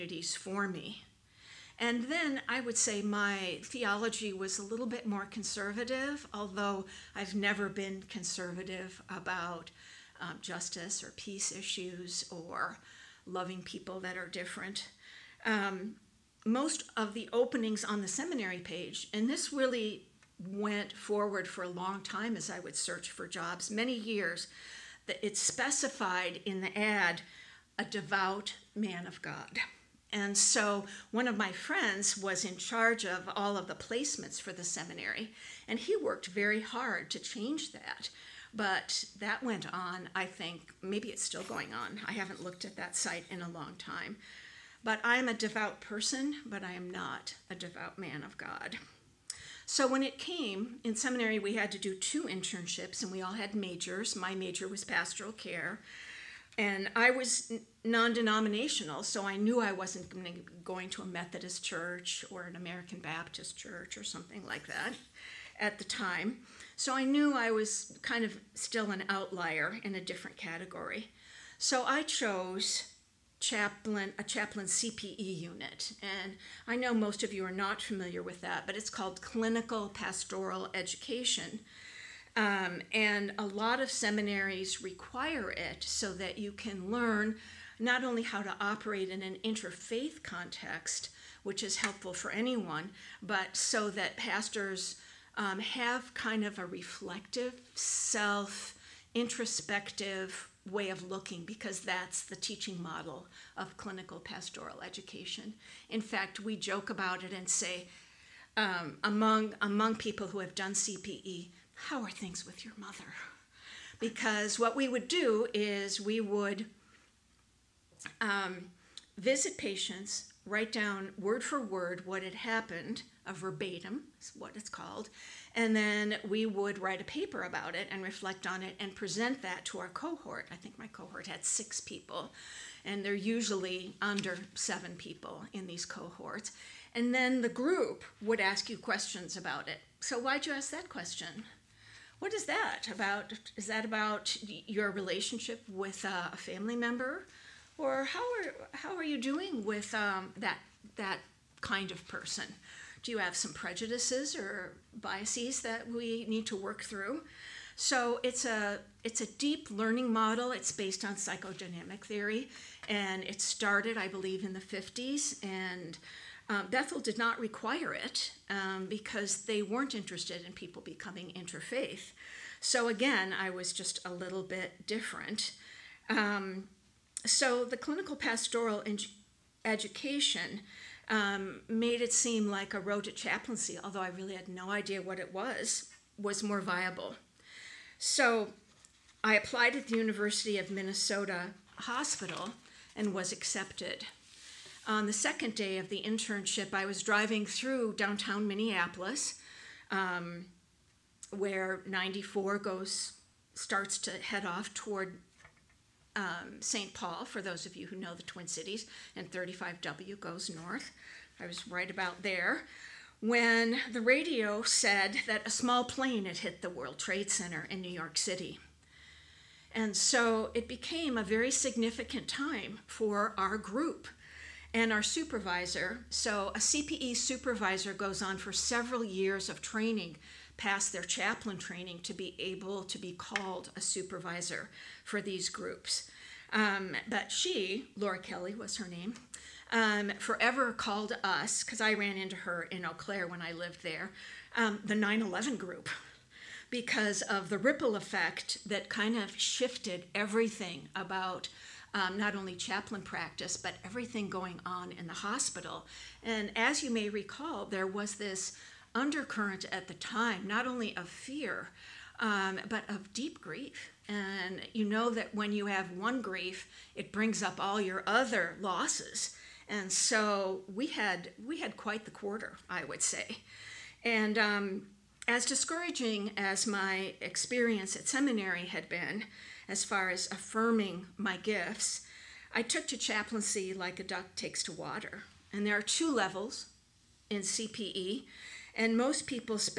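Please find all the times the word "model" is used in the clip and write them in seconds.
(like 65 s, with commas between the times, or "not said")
102 s, 160 s.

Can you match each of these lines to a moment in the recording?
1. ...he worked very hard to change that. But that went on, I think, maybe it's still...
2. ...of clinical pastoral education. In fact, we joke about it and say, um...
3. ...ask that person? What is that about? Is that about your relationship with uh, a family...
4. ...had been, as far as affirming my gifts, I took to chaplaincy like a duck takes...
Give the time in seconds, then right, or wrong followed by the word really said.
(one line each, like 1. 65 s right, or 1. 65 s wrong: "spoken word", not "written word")
1. 35 s right
2. 103 s right
3. 140 s wrong: "question", not "person"
4. 278 s right.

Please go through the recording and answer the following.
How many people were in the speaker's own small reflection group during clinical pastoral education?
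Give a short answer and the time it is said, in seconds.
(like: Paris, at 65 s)
6, at 131 s.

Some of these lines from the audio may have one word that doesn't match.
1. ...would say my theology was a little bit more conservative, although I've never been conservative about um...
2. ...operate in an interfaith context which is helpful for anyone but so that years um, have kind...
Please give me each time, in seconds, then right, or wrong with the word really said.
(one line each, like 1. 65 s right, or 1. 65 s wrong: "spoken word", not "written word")
1. 2 s right
2. 88 s wrong: "pastors", not "years".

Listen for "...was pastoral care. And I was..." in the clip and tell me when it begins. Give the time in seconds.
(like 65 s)
54 s.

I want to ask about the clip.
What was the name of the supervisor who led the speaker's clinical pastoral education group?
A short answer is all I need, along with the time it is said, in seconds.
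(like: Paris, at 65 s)
Laura Kelly, at 237 s.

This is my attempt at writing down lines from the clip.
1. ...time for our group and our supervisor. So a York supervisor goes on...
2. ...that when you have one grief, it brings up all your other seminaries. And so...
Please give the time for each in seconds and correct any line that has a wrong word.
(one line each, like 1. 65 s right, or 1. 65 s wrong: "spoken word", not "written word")
1. 222 s wrong: "CPE", not "York"
2. 265 s wrong: "losses", not "seminaries".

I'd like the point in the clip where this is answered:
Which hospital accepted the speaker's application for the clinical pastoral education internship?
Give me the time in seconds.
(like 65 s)
189 s.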